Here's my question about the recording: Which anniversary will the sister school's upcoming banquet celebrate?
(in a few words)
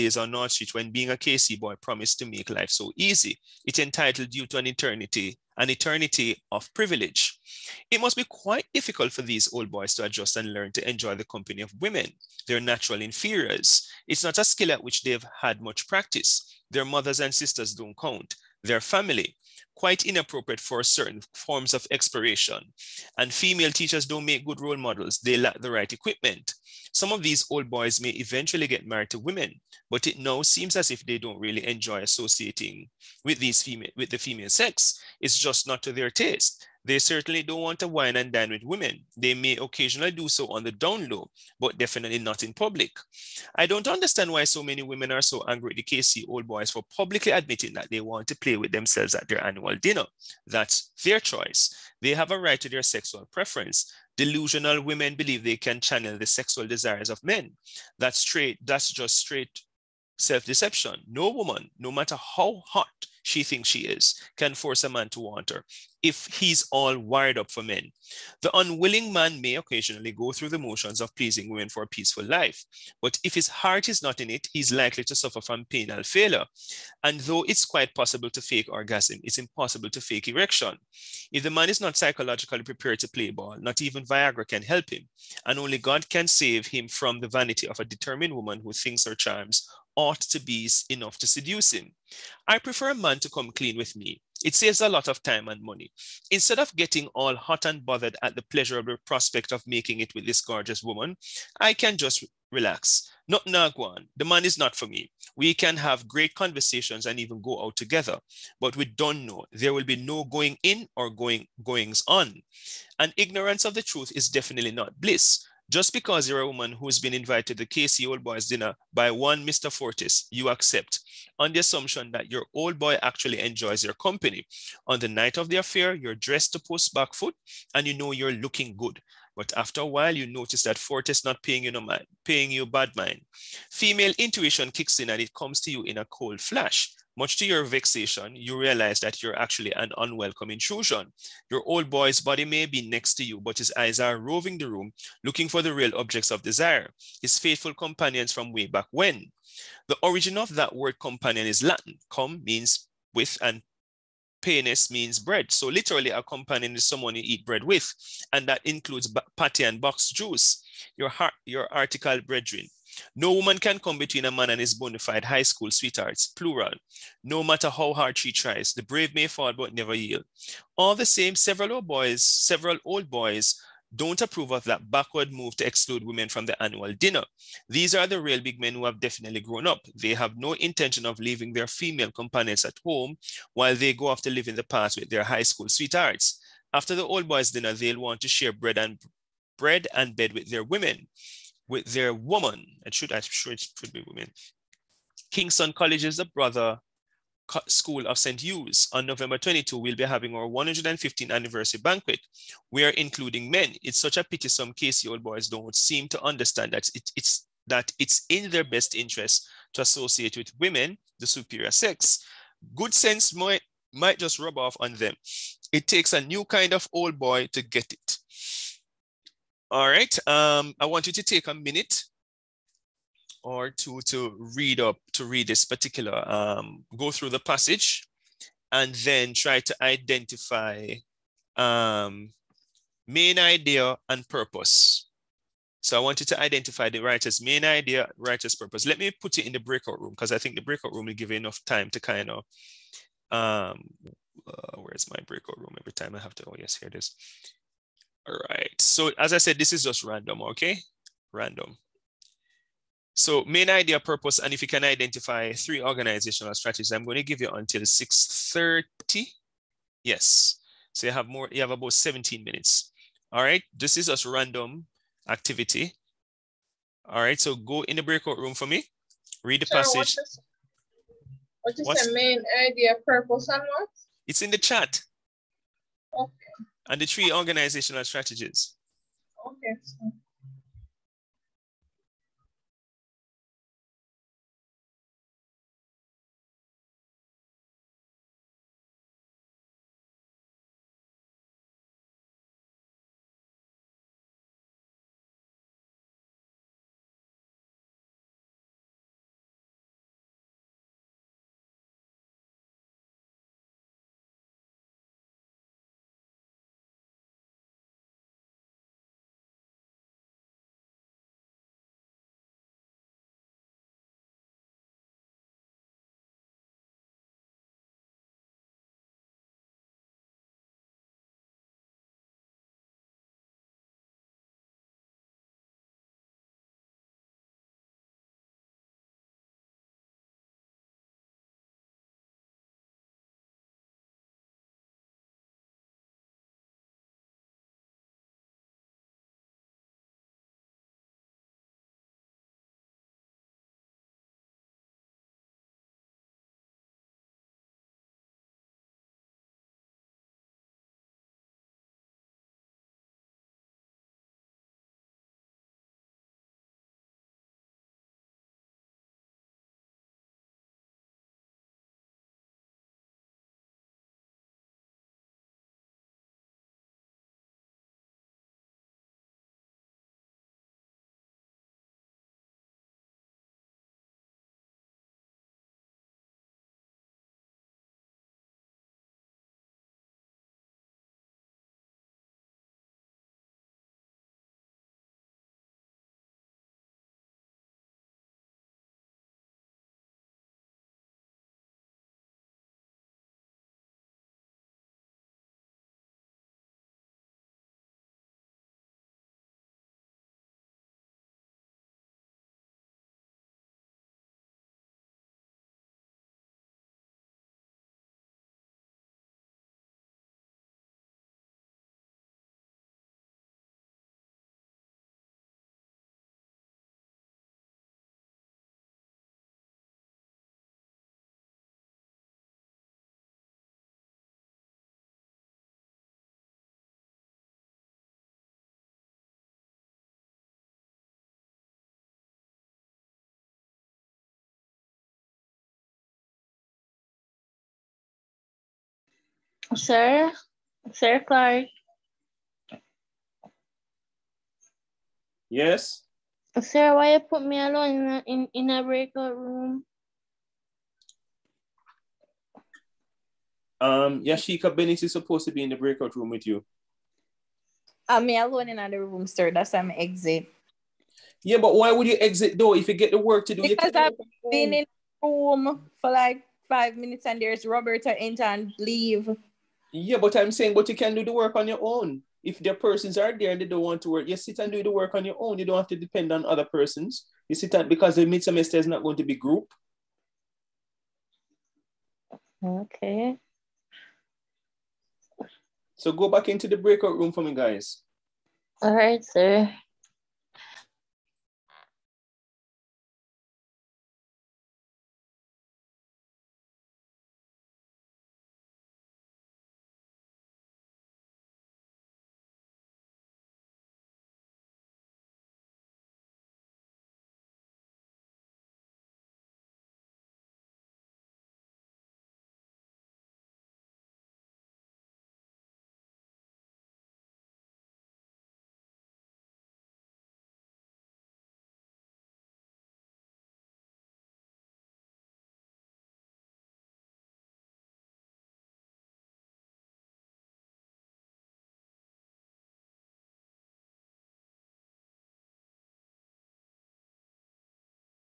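115th.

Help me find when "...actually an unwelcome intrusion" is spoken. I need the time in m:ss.
2:19.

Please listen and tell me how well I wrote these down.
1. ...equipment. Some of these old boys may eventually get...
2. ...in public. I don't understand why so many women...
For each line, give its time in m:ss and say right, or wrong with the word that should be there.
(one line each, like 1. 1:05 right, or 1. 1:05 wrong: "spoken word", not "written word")
1. 0:25 right
2. 0:42 right.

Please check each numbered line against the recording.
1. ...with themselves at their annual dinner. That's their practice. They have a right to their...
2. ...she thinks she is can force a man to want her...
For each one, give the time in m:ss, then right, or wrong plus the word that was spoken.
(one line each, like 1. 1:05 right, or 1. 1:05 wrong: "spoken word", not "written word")
1. 0:48 wrong: "choice", not "practice"
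2. 1:03 right.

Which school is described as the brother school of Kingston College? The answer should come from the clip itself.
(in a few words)
St. Hugh's.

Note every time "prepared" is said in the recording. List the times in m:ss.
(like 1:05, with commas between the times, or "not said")
1:22.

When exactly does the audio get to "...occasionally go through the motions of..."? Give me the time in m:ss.
1:09.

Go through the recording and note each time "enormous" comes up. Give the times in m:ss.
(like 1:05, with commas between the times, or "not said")
not said.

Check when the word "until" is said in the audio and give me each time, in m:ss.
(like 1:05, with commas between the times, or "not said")
4:17.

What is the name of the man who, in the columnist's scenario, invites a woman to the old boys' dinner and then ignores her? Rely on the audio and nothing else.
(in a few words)
Mr. 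Fortis.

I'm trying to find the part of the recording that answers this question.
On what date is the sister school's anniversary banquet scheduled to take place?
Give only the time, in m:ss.
3:19.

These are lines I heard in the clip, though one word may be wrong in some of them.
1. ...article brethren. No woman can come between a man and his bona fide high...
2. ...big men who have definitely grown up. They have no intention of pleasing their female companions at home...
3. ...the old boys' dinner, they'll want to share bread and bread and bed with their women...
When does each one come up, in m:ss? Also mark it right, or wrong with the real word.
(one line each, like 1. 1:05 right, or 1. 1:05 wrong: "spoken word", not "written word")
1. 2:41 right
2. 2:58 wrong: "leaving", not "pleasing"
3. 3:06 right.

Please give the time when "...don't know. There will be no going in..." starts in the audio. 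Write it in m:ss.
1:48.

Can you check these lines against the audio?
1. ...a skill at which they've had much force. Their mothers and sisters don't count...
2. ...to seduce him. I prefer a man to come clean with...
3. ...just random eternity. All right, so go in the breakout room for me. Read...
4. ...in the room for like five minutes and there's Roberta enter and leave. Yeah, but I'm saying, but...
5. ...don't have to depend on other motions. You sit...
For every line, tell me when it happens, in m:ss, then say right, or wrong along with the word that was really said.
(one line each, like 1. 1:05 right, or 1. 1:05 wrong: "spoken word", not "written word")
1. 0:14 wrong: "practice", not "force"
2. 1:31 right
3. 4:24 wrong: "activity", not "eternity"
4. 7:44 right
5. 7:55 wrong: "persons", not "motions".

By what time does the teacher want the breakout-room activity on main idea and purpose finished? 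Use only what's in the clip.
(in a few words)
6:30.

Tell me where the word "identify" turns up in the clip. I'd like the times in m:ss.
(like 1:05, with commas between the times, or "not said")
3:49, 3:56, 4:14.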